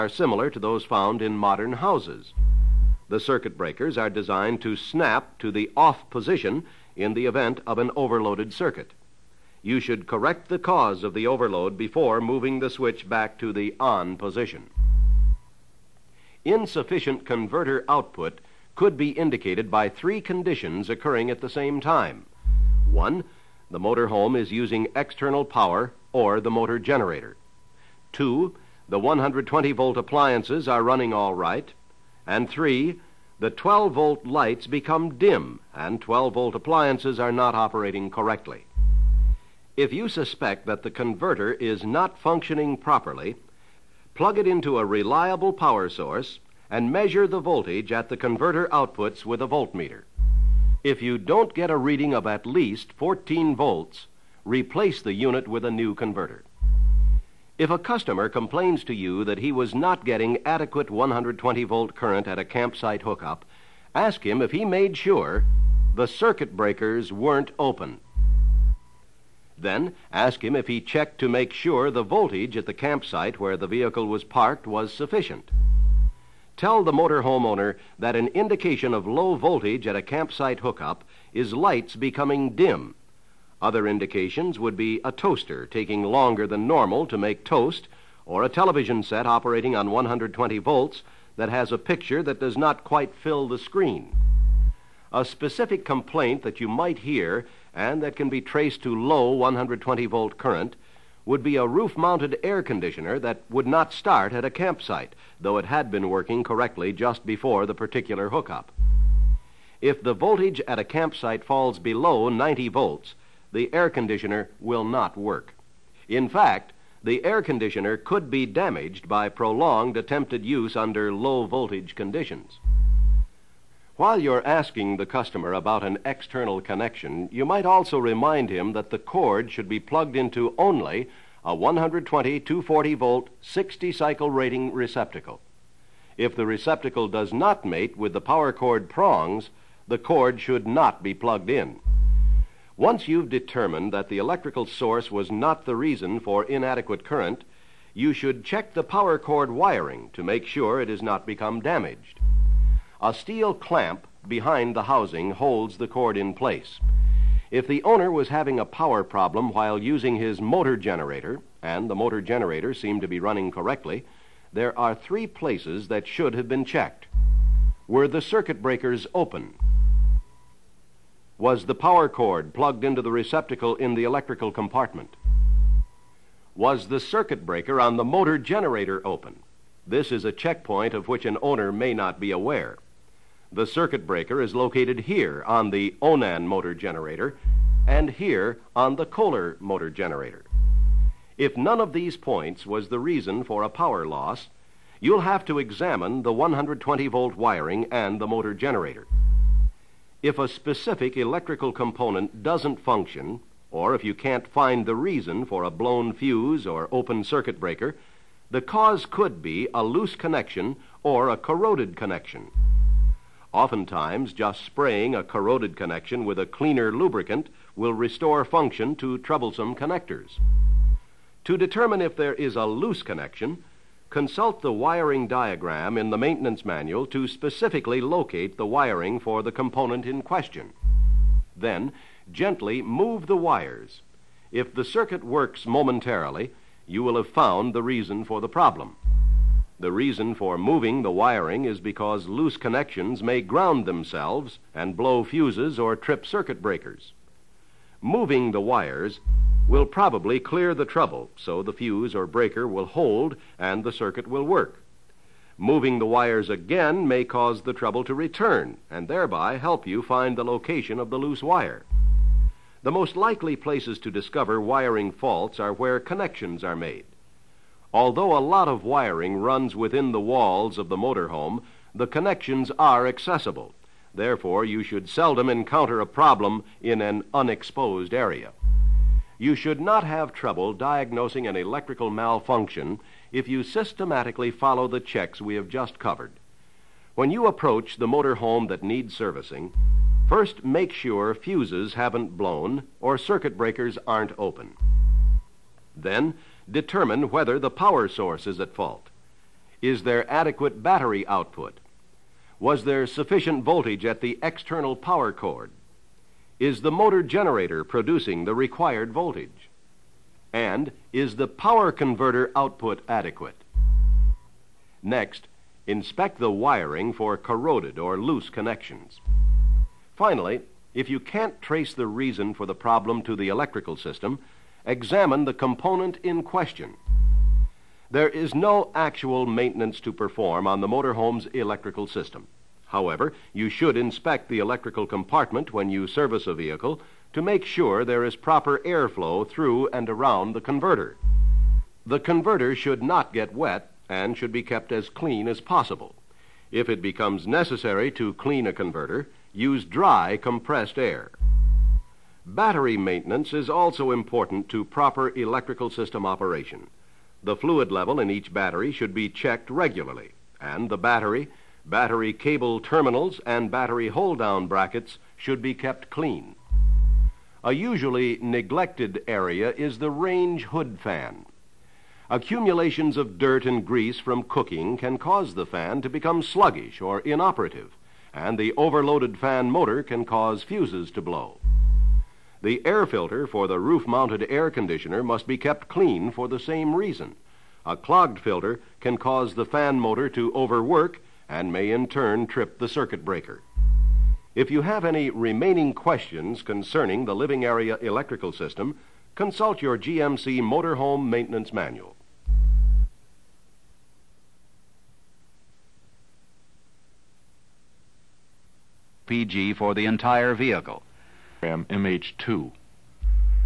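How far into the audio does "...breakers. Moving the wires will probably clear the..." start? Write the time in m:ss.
4:06.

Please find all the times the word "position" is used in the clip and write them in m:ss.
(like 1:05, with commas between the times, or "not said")
0:06, 0:14.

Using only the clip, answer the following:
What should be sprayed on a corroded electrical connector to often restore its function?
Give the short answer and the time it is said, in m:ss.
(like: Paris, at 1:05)
cleaner lubricant, at 3:36.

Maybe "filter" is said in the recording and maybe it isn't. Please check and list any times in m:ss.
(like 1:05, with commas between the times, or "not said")
6:23, 6:28.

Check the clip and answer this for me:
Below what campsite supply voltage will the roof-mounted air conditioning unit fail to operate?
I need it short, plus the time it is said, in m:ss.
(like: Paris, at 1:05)
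90 volts, at 1:52.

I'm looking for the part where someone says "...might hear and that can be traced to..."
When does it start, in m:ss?
1:36.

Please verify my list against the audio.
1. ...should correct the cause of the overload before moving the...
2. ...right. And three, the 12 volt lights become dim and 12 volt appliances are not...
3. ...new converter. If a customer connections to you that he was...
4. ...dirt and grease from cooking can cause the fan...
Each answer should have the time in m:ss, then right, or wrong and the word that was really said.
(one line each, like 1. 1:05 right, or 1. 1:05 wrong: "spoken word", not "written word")
1. 0:09 right
2. 0:31 right
3. 0:55 wrong: "complains", not "connections"
4. 6:13 right.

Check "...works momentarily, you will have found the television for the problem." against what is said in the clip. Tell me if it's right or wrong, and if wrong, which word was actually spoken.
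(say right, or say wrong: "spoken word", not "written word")
wrong: "reason", not "television".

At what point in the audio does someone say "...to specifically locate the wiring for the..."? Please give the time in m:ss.
3:47.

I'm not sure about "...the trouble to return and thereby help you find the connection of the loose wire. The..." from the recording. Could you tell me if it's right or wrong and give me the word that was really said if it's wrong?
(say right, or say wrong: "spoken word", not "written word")
wrong: "location", not "connection".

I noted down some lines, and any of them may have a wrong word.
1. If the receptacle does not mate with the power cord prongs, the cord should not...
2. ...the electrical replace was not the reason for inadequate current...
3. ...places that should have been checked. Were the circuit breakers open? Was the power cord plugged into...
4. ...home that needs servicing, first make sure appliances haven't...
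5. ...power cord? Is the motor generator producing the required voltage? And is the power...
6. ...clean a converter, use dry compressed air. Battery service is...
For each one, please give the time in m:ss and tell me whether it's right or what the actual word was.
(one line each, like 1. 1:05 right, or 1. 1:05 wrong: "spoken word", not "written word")
1. 2:16 right
2. 2:24 wrong: "source", not "replace"
3. 2:45 right
4. 4:48 wrong: "fuses", not "appliances"
5. 5:04 right
6. 5:48 wrong: "maintenance", not "service".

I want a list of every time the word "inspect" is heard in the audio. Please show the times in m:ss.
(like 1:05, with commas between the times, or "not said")
5:15, 5:33.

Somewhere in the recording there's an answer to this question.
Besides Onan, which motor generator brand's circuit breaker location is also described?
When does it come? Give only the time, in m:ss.
3:09.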